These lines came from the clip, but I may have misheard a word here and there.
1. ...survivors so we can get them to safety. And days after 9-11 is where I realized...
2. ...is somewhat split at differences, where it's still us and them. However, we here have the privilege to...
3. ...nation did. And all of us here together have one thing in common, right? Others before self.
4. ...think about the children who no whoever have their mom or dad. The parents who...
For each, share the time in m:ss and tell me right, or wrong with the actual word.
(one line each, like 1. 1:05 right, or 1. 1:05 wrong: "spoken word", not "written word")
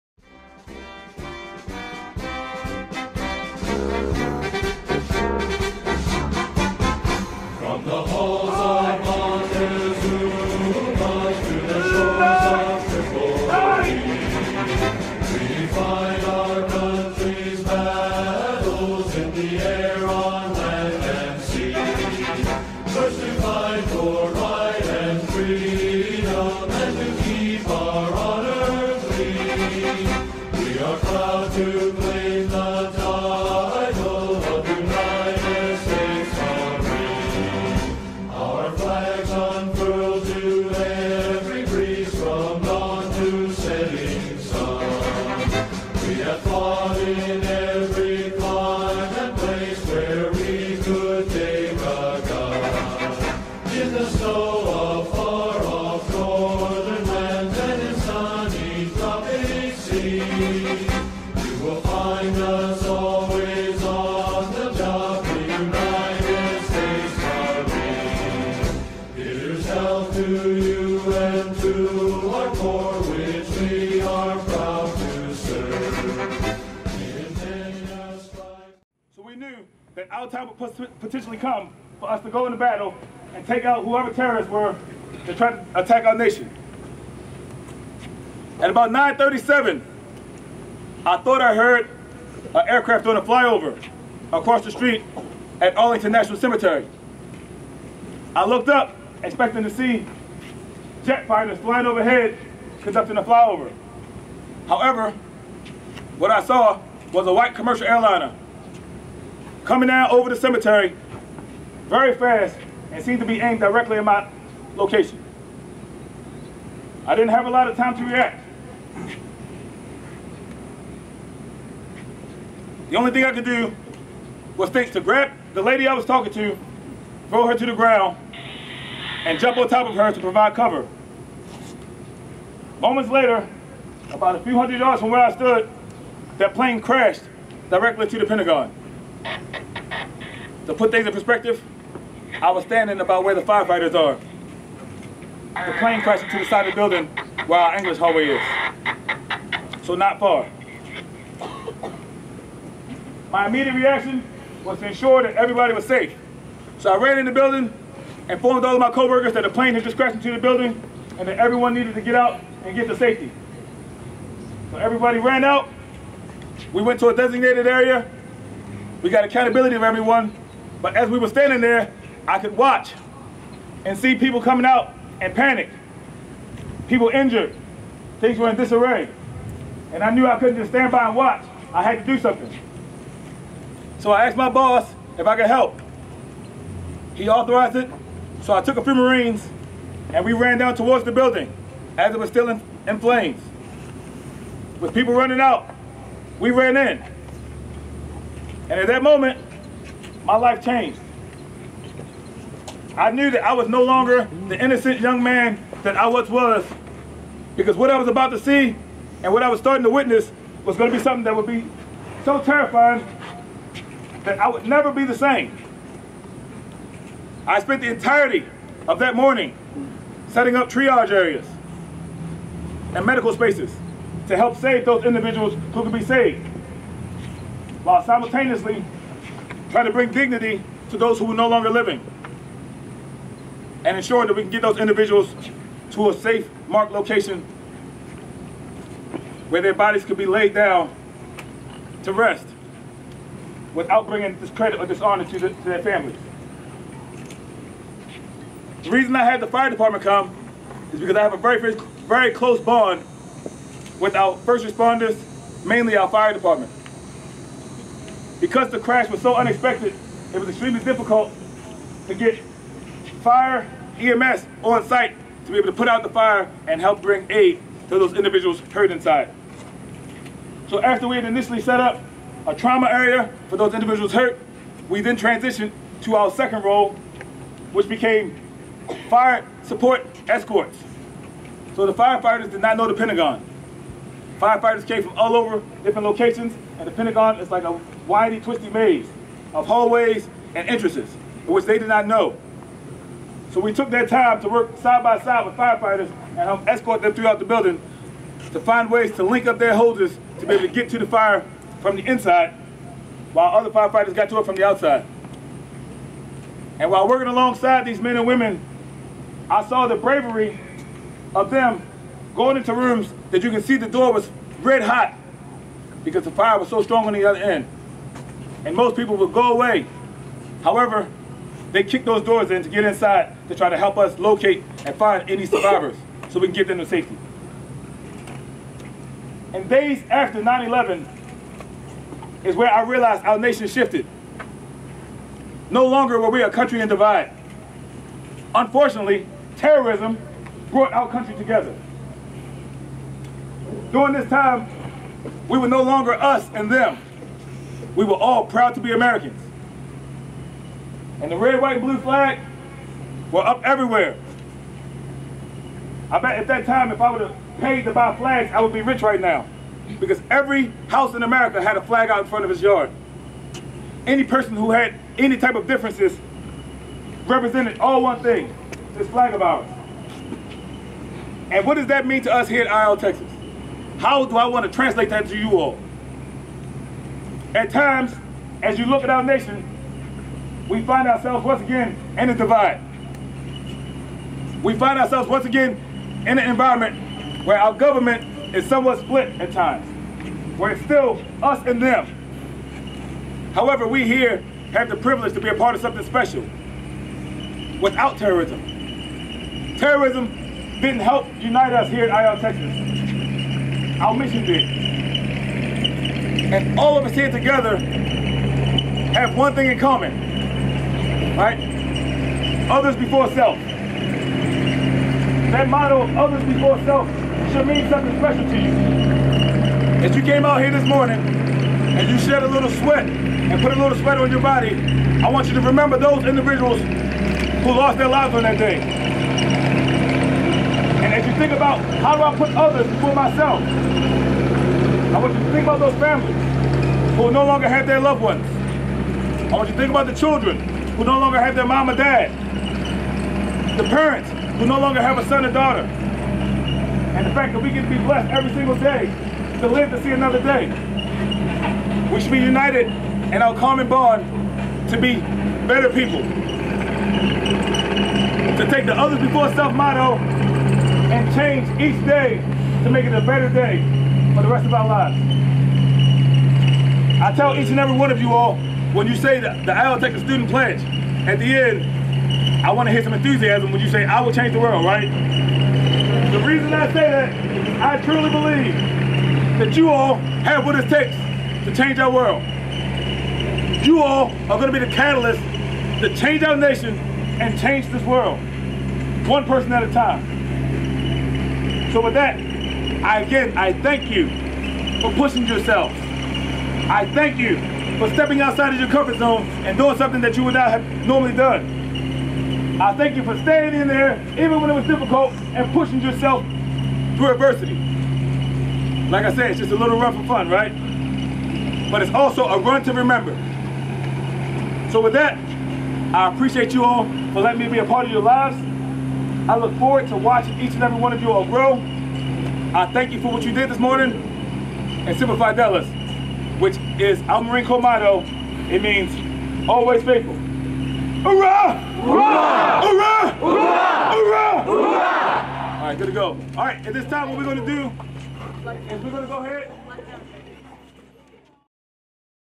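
1. 5:25 right
2. 6:28 wrong: "times", not "differences"
3. 6:44 wrong: "mission", not "nation"
4. 7:19 wrong: "longer", not "whoever".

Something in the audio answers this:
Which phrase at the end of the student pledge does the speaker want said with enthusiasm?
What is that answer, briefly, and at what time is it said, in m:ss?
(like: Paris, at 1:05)
I will change the world, at 7:54.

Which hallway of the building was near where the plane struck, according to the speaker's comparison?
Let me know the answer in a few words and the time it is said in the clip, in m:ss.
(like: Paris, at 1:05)
English hallway, at 2:27.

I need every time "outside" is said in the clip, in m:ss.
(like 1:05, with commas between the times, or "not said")
5:04, 8:18.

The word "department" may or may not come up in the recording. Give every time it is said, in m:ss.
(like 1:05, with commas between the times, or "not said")
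4:09, 4:16.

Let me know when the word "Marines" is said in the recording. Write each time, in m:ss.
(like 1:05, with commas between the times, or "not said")
3:08, 8:47.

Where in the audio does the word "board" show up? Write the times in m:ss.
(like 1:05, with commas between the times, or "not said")
not said.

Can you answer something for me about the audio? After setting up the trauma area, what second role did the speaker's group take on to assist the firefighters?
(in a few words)
Fire support escorts.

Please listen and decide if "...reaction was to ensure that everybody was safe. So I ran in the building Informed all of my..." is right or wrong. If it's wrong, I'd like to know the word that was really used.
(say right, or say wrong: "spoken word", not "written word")
right.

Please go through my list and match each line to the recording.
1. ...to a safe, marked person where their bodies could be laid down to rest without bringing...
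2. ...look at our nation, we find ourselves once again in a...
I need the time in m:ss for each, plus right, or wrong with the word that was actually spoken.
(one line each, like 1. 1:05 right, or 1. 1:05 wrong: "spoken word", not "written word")
1. 3:55 wrong: "location", not "person"
2. 6:18 right.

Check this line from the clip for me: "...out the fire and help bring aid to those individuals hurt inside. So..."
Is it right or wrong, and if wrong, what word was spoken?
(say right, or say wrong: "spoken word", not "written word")
right.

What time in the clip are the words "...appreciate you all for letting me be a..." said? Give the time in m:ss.
8:36.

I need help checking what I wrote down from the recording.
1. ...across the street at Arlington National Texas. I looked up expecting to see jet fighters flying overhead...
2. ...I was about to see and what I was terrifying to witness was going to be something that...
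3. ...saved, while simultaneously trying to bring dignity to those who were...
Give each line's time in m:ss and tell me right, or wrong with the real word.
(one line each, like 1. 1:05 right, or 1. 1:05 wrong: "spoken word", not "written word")
1. 1:34 wrong: "Cemetery", not "Texas"
2. 3:27 wrong: "starting", not "terrifying"
3. 3:46 right.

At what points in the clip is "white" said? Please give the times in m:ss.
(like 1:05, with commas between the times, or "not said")
1:47, 5:51.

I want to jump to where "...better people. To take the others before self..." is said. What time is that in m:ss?
7:35.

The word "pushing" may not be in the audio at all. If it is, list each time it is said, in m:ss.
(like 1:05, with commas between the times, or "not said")
8:15, 8:25.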